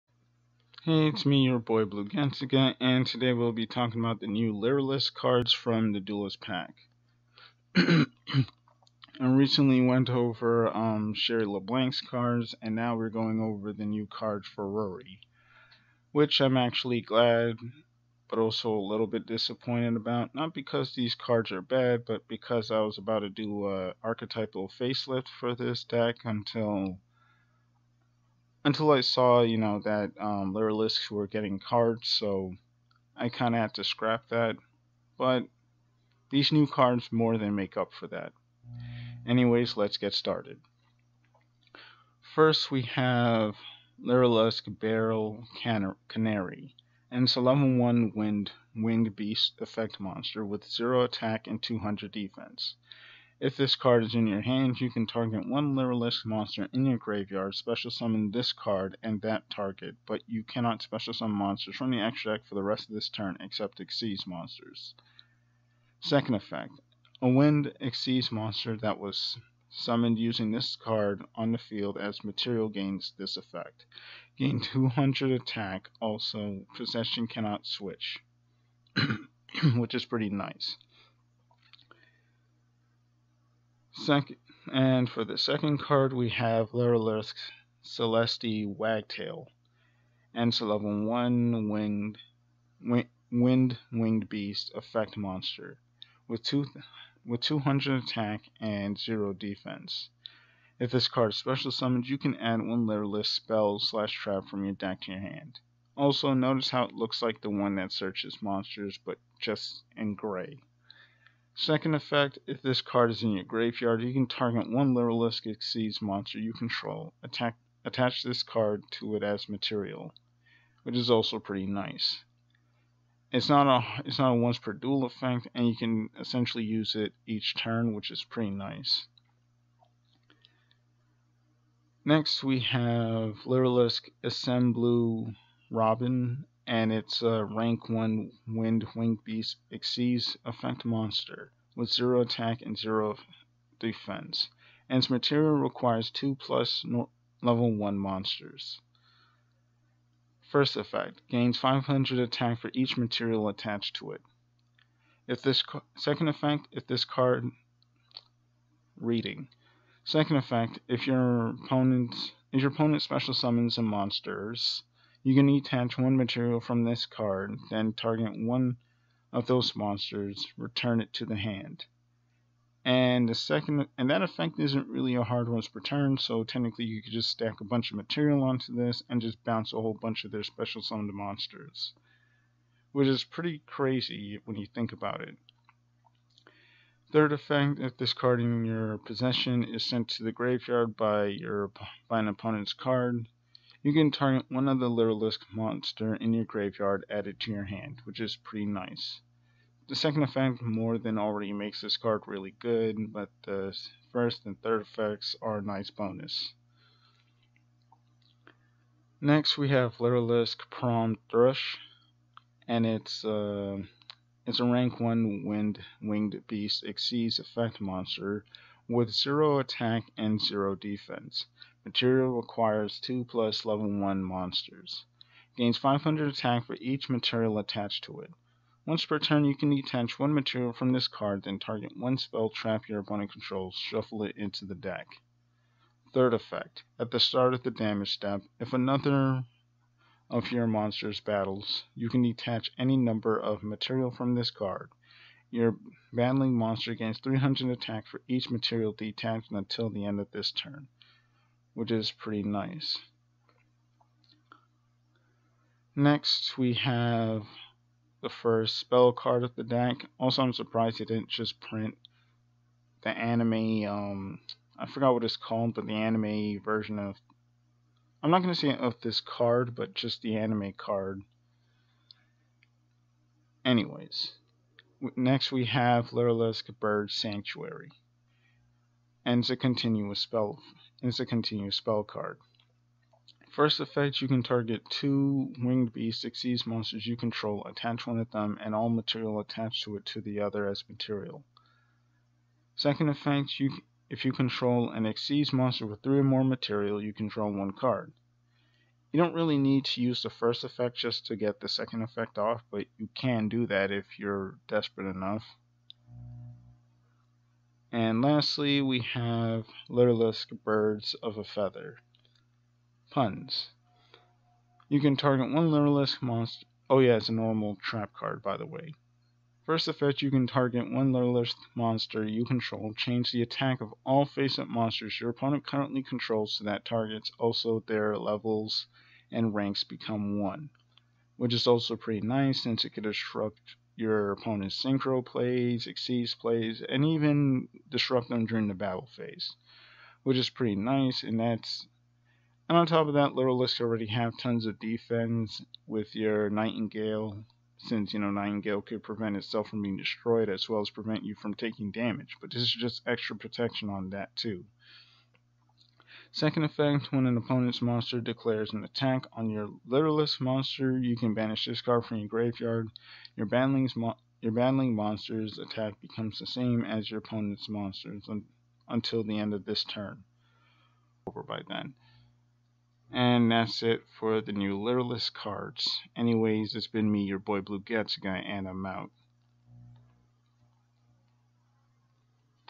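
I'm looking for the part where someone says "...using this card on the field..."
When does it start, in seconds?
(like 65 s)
70 s.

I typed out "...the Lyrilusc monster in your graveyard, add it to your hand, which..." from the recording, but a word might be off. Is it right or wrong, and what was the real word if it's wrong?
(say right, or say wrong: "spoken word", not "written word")
right.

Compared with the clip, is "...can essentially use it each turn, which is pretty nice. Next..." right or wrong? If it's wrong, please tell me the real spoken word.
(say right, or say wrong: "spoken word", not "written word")
right.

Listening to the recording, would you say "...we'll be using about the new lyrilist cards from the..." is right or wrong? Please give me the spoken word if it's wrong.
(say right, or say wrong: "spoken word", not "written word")
wrong: "talking", not "using".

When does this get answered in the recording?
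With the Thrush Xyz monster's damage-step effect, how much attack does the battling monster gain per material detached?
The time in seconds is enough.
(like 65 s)
247 s.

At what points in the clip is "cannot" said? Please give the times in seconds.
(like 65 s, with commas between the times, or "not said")
60 s, 77 s.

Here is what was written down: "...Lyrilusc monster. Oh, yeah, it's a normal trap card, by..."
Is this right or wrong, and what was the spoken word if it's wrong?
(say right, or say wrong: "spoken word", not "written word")
right.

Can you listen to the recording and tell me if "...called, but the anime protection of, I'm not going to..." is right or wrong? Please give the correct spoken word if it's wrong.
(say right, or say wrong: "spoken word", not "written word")
wrong: "version", not "protection".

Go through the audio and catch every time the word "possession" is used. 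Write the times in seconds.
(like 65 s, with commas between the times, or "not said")
76 s, 188 s.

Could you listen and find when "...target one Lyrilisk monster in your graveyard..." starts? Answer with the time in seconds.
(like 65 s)
55 s.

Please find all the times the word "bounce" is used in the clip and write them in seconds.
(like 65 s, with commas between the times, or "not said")
179 s.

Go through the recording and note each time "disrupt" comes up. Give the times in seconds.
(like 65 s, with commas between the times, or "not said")
333 s, 337 s.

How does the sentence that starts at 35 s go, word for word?
But these new cards more than make up for that.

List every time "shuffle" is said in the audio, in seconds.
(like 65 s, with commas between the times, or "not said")
233 s.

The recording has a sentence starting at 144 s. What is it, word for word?
And its material requires 2 plus no level 1 monsters.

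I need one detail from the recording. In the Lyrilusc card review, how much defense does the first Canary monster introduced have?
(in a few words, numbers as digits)
200.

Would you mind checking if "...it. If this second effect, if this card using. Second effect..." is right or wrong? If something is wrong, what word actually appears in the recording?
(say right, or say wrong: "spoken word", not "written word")
wrong: "reading", not "using".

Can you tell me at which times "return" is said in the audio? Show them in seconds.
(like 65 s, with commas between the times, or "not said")
170 s.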